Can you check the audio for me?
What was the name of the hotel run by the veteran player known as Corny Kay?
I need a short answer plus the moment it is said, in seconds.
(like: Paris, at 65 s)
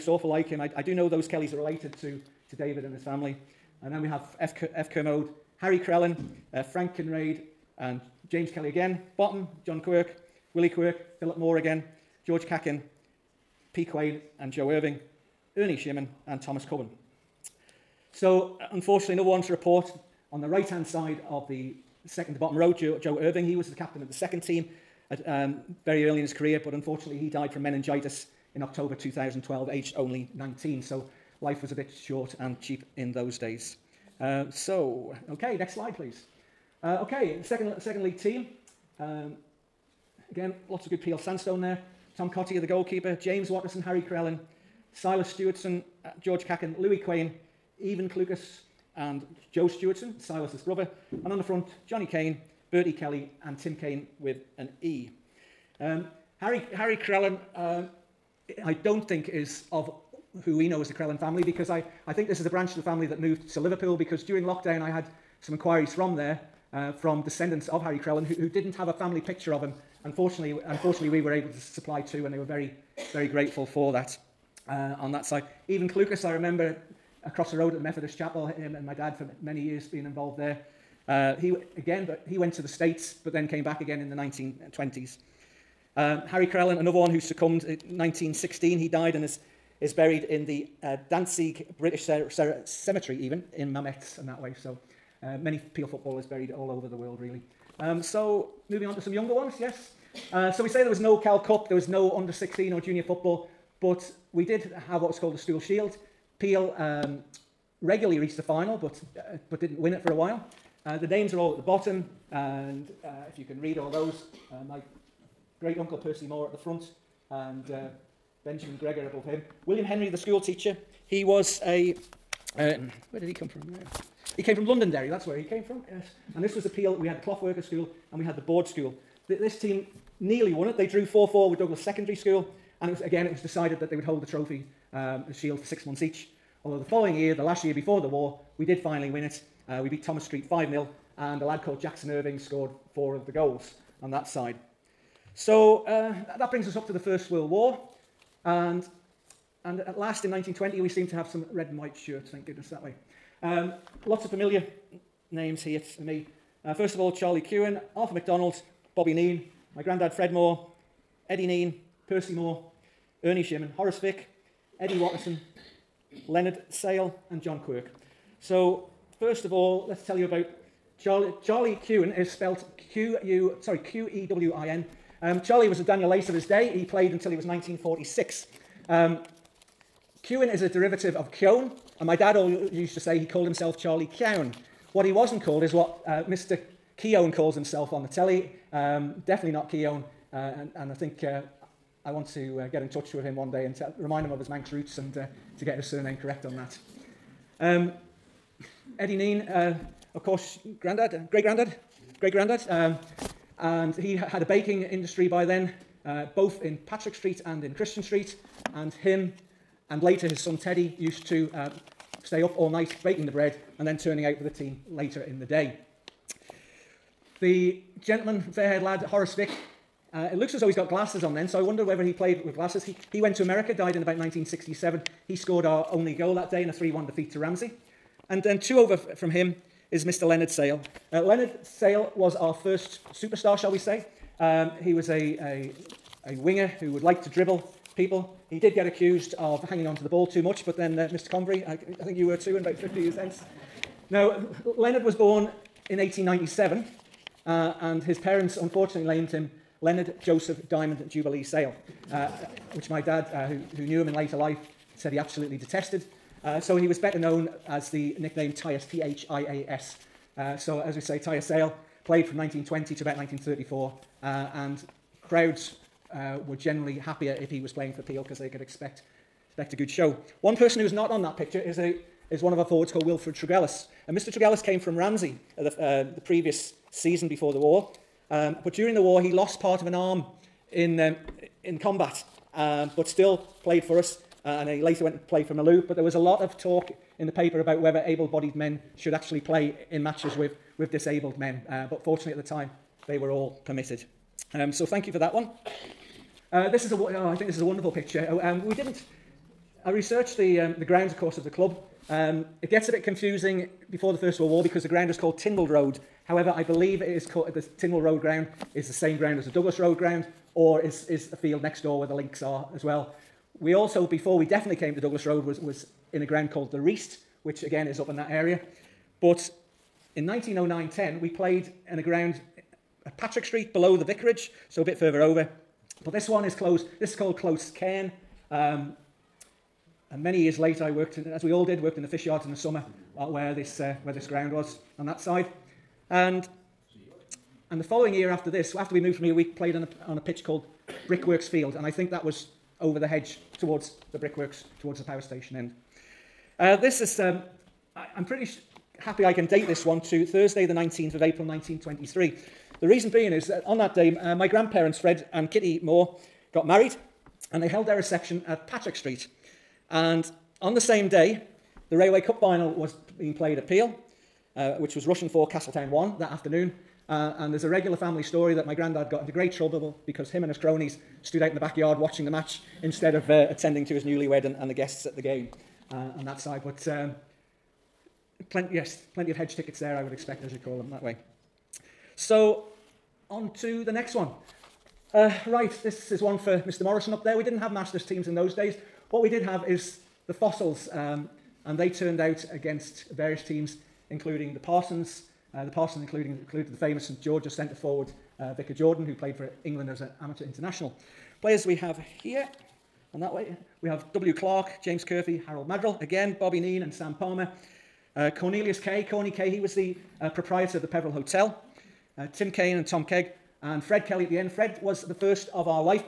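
Peveril Hotel, at 410 s.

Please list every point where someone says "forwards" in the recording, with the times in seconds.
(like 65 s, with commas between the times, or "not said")
272 s, 397 s.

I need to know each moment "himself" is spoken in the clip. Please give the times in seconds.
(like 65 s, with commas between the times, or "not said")
183 s, 187 s.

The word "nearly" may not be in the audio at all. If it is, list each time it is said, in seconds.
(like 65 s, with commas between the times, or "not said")
130 s.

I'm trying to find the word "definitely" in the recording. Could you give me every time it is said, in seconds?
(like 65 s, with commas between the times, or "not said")
189 s, 314 s.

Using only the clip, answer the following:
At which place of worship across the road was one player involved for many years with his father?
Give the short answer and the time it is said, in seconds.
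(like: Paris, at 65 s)
the Methodist Chapel, at 77 s.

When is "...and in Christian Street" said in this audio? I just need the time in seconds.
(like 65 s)
207 s.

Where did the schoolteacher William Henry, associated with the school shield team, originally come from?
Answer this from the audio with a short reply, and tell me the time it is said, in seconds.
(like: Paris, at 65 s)
Londonderry, at 124 s.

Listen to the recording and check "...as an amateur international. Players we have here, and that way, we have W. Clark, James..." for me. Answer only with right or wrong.
right.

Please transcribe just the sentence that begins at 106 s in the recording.
Peel um, regularly reached the final, but uh, but didn't win it for a while.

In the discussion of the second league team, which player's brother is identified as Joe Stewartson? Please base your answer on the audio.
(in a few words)
Silas Stewartson.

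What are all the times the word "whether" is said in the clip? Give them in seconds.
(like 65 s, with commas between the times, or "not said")
221 s, 287 s.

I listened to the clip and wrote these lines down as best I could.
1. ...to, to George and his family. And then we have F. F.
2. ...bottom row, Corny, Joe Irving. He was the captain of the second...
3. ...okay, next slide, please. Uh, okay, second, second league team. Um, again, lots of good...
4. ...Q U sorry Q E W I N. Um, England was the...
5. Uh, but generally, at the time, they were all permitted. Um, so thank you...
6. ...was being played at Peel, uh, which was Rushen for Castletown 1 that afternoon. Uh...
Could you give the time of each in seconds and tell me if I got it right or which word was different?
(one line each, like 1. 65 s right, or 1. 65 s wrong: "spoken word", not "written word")
1. 2 s wrong: "David", not "George"
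2. 22 s wrong: "Joe", not "Corny"
3. 35 s right
4. 172 s wrong: "Charlie", not "England"
5. 291 s wrong: "fortunately", not "generally"
6. 362 s right.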